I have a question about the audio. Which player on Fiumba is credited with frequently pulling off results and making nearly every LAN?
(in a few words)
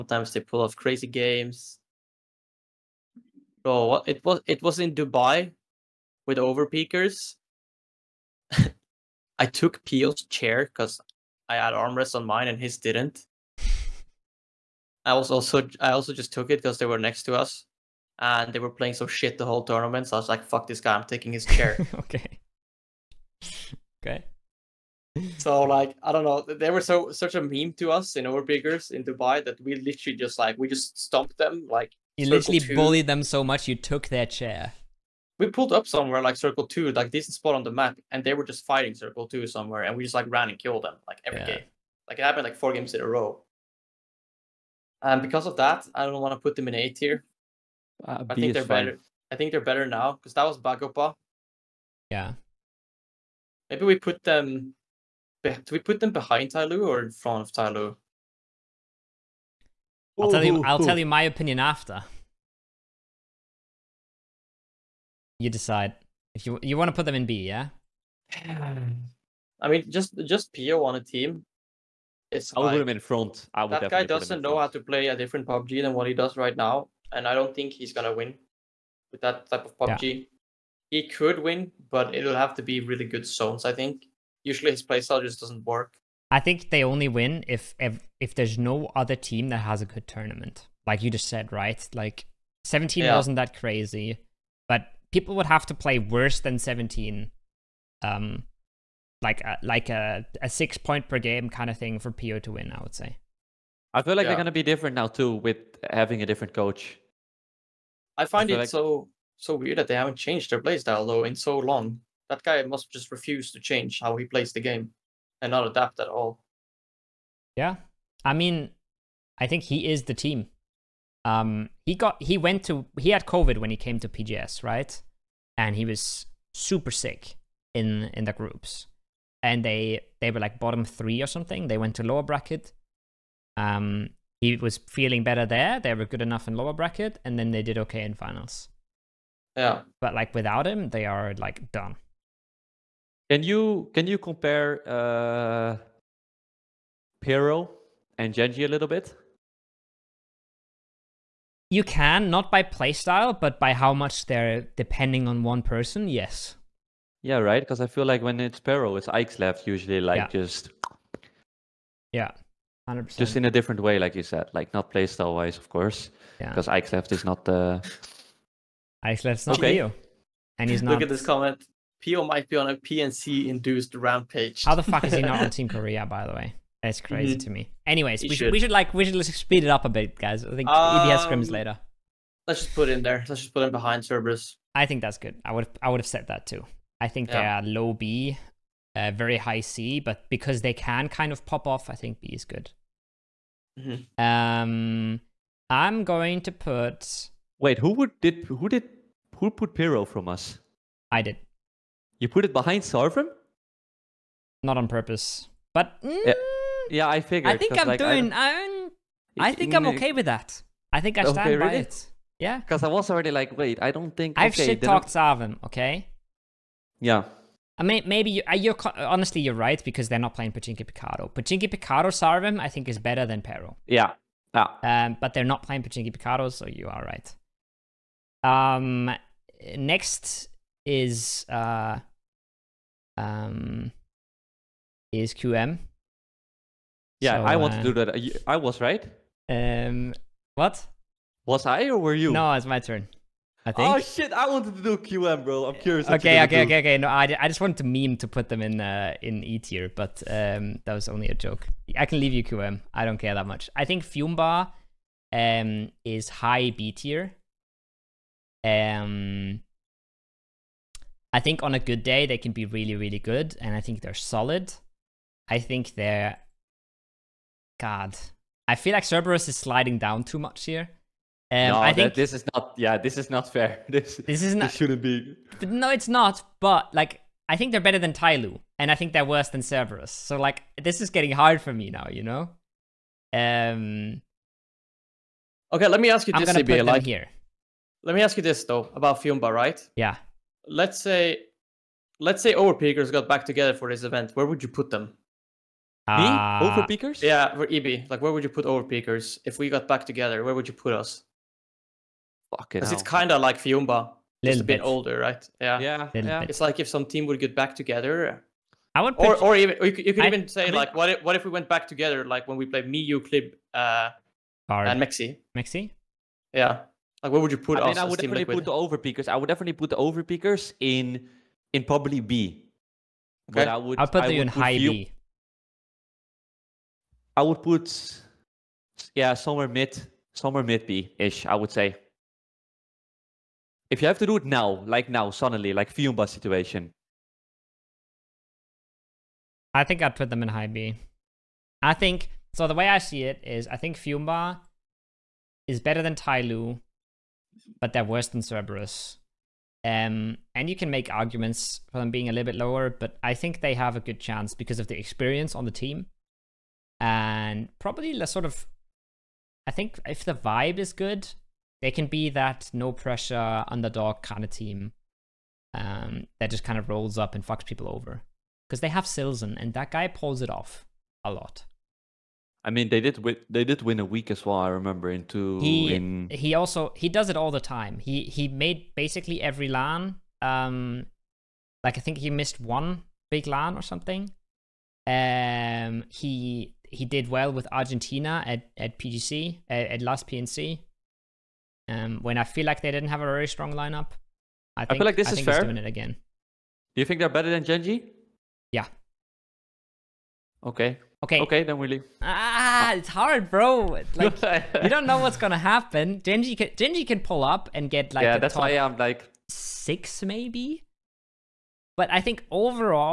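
Silson.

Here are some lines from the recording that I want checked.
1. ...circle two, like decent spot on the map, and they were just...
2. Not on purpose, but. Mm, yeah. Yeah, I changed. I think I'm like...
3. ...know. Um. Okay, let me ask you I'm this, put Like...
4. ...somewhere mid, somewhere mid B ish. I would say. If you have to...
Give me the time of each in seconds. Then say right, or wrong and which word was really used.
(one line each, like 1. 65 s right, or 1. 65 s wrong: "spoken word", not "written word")
1. 36 s right
2. 204 s wrong: "figured", not "changed"
3. 282 s right
4. 329 s right.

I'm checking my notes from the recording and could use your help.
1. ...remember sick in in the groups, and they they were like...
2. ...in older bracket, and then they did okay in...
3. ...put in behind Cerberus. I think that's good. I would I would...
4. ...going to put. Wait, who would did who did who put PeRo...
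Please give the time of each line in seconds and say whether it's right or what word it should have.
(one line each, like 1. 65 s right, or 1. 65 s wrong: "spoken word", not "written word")
1. 126 s wrong: "super", not "remember"
2. 136 s wrong: "lower", not "older"
3. 183 s right
4. 196 s right.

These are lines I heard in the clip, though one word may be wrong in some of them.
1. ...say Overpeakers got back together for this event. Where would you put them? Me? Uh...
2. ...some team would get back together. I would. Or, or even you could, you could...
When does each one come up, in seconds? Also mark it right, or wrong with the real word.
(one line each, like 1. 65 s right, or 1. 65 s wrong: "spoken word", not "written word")
1. 292 s right
2. 306 s right.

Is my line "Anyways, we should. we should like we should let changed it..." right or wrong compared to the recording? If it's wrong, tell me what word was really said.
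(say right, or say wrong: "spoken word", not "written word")
wrong: "speed", not "changed".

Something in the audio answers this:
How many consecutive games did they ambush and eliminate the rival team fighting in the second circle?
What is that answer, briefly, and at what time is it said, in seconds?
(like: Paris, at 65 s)
4, at 42 s.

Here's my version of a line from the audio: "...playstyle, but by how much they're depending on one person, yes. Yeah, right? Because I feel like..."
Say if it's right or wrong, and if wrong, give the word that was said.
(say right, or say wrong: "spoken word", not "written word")
right.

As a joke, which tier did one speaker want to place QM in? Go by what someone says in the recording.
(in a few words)
E tier.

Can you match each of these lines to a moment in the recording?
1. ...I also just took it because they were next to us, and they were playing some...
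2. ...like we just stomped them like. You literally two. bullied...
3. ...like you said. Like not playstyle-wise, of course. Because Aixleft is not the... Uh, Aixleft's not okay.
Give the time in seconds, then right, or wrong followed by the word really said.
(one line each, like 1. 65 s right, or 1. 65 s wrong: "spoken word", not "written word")
1. 15 s right
2. 30 s right
3. 163 s right.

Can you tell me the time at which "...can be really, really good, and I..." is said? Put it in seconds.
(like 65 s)
262 s.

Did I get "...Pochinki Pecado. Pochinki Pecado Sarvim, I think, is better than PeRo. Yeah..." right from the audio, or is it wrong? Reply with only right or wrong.
right.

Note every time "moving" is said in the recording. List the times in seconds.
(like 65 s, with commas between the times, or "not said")
not said.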